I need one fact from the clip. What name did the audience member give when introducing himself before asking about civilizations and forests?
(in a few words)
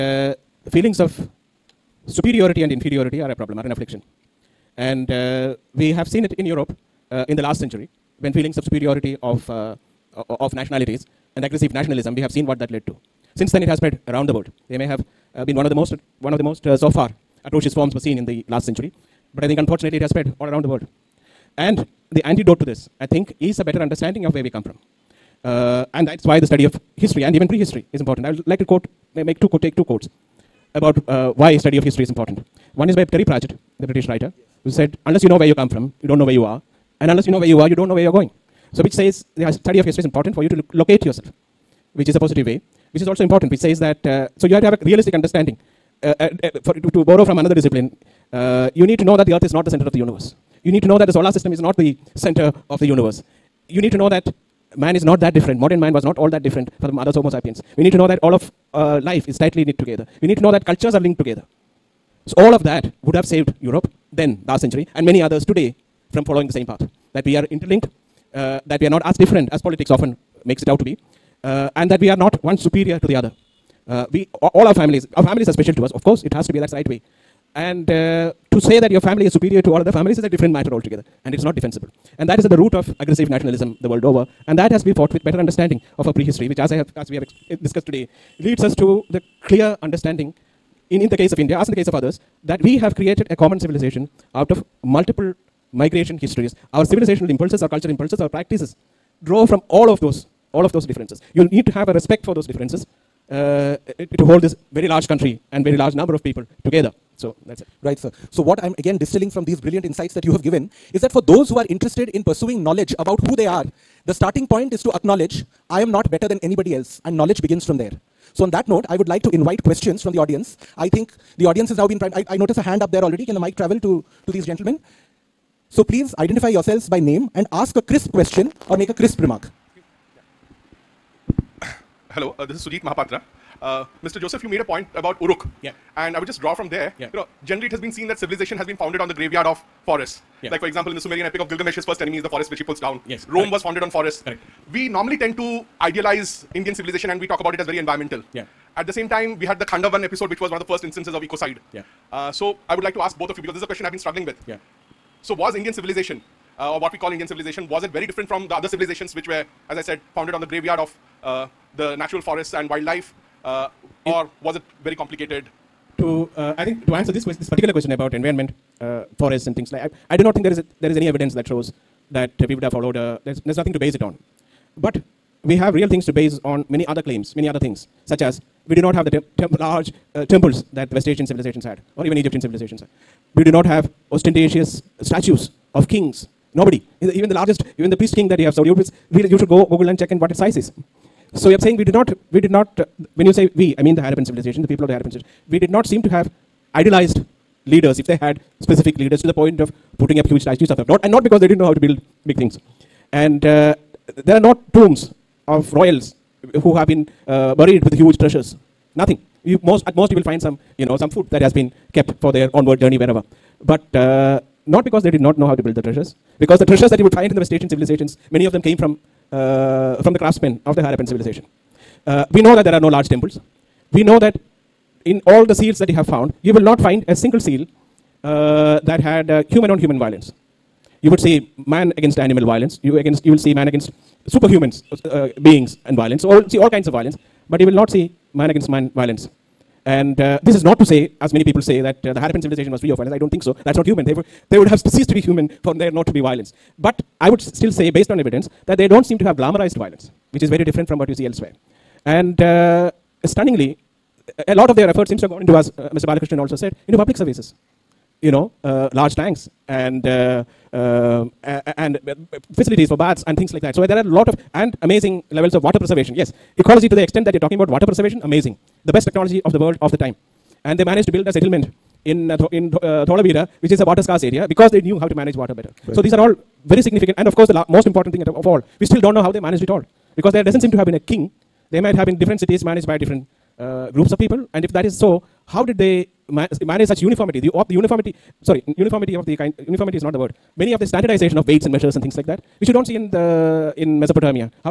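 Sujit Mahapatra.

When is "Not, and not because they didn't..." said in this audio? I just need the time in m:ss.
3:20.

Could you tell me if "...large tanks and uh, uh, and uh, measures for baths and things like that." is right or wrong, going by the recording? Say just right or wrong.
wrong.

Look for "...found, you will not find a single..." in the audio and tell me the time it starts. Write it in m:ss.
3:46.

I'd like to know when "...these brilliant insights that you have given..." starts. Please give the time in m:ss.
1:49.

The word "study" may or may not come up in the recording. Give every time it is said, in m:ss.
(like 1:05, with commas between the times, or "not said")
0:26, 0:31, 0:39.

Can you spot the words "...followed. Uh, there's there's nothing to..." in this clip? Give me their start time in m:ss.
2:52.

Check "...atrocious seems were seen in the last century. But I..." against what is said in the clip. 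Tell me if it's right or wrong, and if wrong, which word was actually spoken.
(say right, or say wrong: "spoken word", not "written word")
wrong: "forms", not "seems".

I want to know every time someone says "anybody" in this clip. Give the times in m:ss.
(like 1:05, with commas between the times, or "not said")
1:56.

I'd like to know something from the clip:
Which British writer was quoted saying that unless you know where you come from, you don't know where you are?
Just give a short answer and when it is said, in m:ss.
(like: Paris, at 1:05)
Terry Pratchett, at 0:33.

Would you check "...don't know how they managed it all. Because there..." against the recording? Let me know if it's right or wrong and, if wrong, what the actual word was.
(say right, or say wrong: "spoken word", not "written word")
right.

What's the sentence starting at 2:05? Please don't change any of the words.
So, please identify yourselves by name and ask a crisp question or make a crisp remark.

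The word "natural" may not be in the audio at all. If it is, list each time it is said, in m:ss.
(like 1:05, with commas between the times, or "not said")
2:41.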